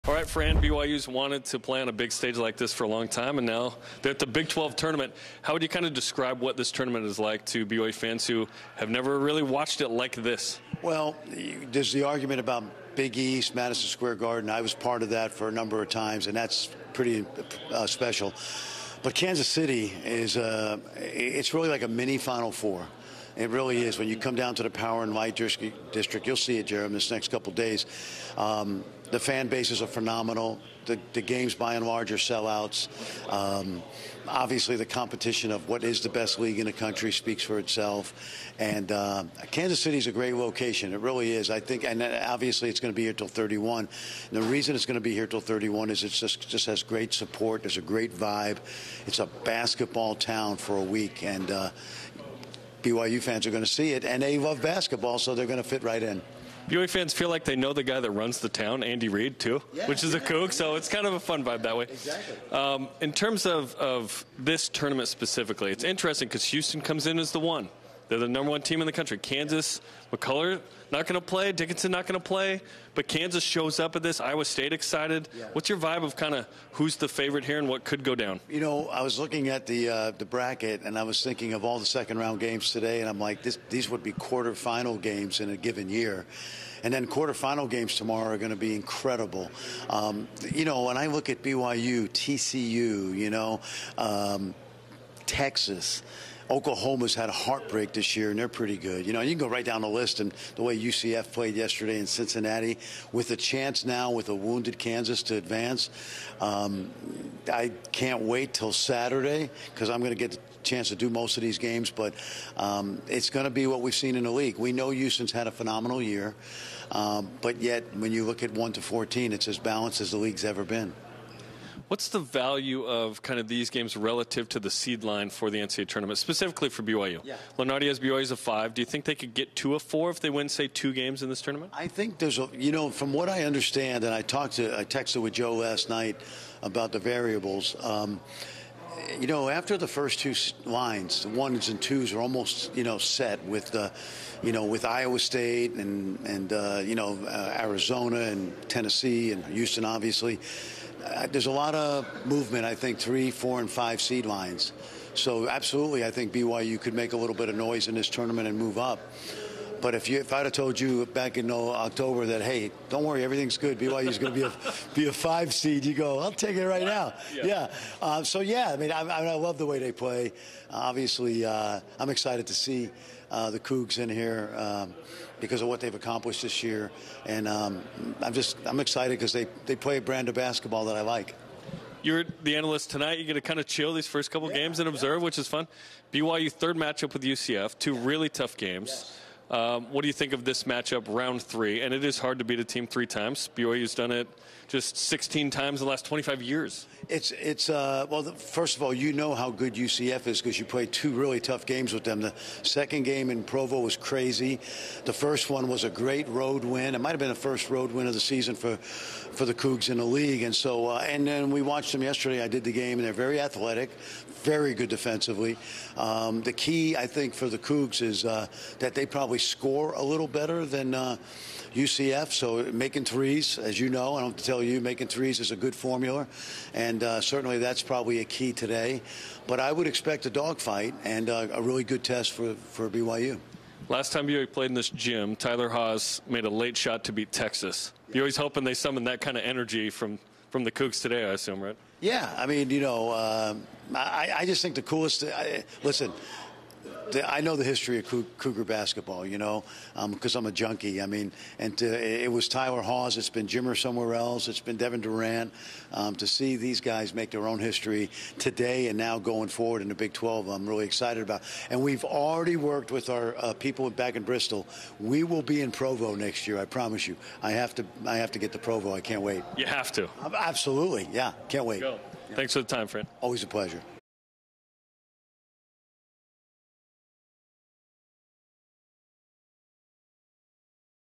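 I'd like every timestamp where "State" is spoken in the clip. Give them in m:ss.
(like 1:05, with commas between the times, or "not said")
1:14, 2:25.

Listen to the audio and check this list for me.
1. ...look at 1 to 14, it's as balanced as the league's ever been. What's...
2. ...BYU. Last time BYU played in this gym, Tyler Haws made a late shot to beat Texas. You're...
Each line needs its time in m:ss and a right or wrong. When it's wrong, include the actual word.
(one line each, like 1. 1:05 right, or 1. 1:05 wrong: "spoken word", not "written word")
1. 1:58 right
2. 3:52 right.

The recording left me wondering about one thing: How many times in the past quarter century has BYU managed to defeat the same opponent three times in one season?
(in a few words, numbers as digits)
16.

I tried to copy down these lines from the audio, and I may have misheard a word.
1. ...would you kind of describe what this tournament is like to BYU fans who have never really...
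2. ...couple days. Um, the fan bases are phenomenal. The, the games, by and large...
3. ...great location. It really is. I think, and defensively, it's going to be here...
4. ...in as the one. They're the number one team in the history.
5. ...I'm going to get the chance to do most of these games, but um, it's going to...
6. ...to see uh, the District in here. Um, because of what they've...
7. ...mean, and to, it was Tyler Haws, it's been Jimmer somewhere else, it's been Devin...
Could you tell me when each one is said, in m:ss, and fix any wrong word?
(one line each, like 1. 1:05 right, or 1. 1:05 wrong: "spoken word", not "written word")
1. 0:05 right
2. 0:27 right
3. 0:40 wrong: "obviously", not "defensively"
4. 1:07 wrong: "country", not "history"
5. 1:49 right
6. 2:52 wrong: "Cougs", not "District"
7. 4:11 right.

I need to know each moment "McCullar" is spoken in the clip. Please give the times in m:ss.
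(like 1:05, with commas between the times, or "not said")
1:10.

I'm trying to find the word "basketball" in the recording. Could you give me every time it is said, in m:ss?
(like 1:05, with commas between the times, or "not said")
0:49, 0:54, 3:00, 4:08.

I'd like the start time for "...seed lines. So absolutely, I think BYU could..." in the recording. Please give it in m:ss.
2:34.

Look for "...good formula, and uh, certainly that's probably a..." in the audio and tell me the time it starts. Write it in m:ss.
3:45.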